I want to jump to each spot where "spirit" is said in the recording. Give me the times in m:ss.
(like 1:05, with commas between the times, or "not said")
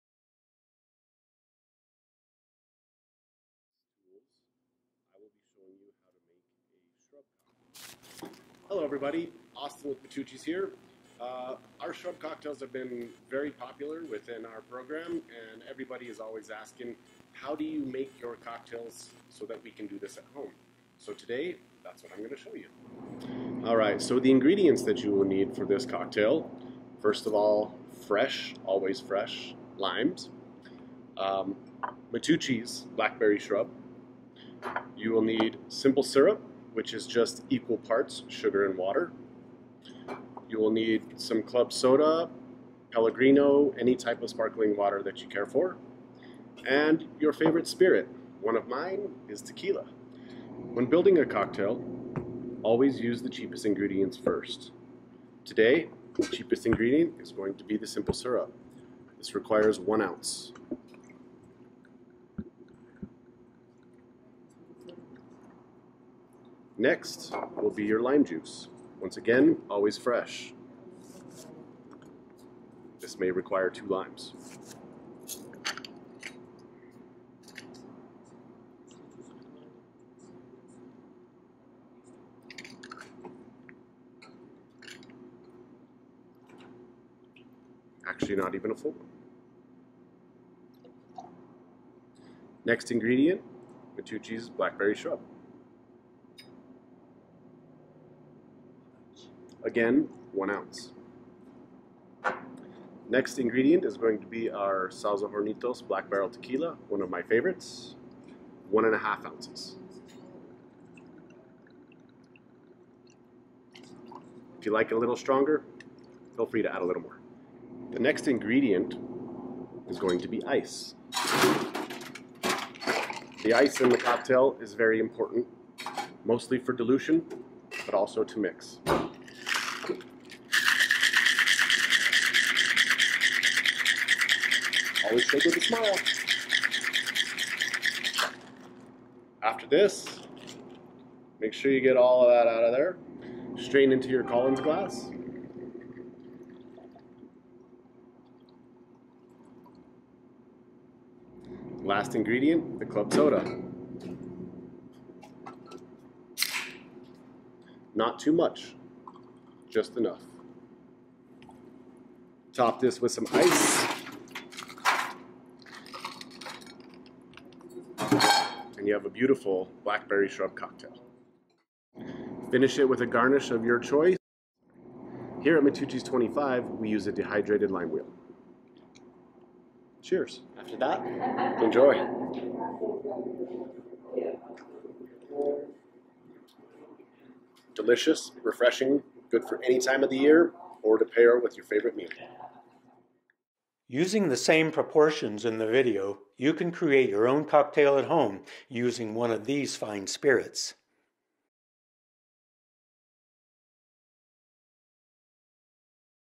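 0:47, 3:20.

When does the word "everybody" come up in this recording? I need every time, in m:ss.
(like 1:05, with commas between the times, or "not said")
0:08, 0:15.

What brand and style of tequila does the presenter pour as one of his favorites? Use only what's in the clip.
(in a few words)
Sauza Hornitos Black Barrel.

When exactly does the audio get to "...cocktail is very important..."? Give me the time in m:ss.
2:03.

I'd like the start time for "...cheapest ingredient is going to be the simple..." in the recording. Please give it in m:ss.
0:56.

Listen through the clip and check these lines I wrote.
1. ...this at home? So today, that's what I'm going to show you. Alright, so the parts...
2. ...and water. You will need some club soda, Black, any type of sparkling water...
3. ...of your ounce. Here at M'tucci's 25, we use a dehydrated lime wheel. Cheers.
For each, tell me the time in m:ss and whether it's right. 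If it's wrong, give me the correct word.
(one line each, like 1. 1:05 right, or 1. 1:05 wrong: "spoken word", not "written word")
1. 0:19 wrong: "ingredients", not "parts"
2. 0:38 wrong: "Pellegrino", not "Black"
3. 2:53 wrong: "choice", not "ounce".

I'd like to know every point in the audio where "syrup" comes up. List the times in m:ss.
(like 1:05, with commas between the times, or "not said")
0:36, 0:58.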